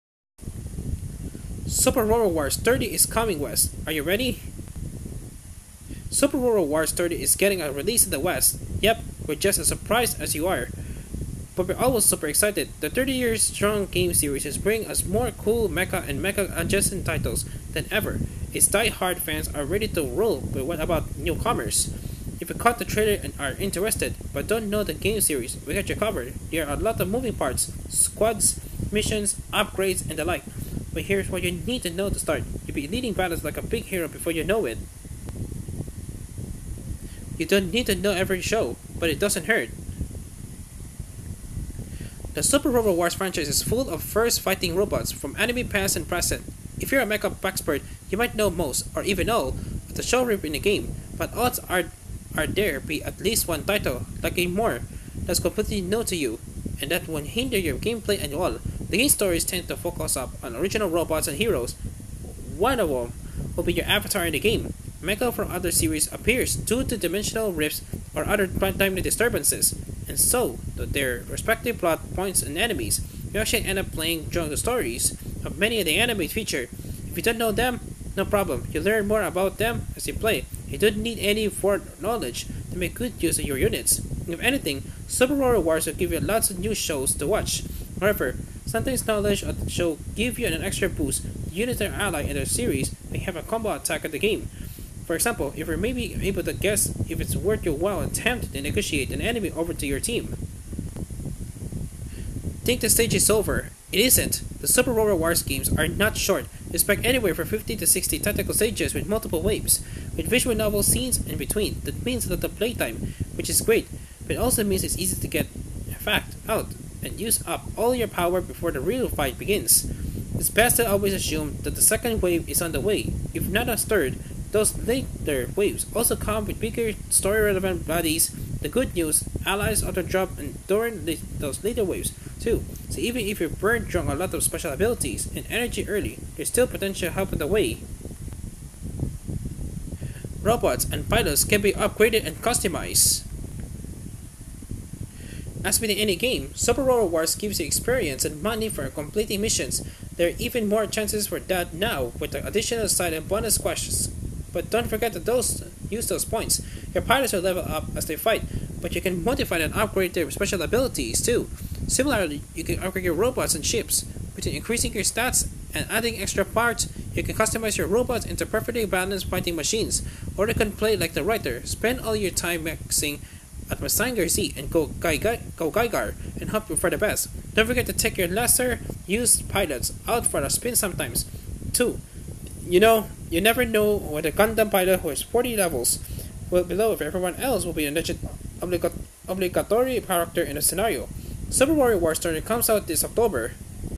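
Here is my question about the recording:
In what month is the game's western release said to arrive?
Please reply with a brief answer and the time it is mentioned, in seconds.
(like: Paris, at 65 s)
October, at 193 s.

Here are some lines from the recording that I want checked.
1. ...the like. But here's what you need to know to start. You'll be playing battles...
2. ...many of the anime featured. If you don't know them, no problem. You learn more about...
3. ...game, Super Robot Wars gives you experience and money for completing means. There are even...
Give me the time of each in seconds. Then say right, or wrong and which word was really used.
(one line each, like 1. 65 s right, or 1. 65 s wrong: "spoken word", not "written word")
1. 30 s wrong: "leading", not "playing"
2. 75 s right
3. 146 s wrong: "missions", not "means".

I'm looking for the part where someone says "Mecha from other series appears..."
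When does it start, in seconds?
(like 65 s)
65 s.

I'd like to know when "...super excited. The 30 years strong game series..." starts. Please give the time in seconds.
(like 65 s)
12 s.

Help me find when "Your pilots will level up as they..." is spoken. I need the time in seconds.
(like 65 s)
156 s.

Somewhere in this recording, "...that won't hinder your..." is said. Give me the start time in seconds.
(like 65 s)
56 s.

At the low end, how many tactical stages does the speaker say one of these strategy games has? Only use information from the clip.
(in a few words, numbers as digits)
50.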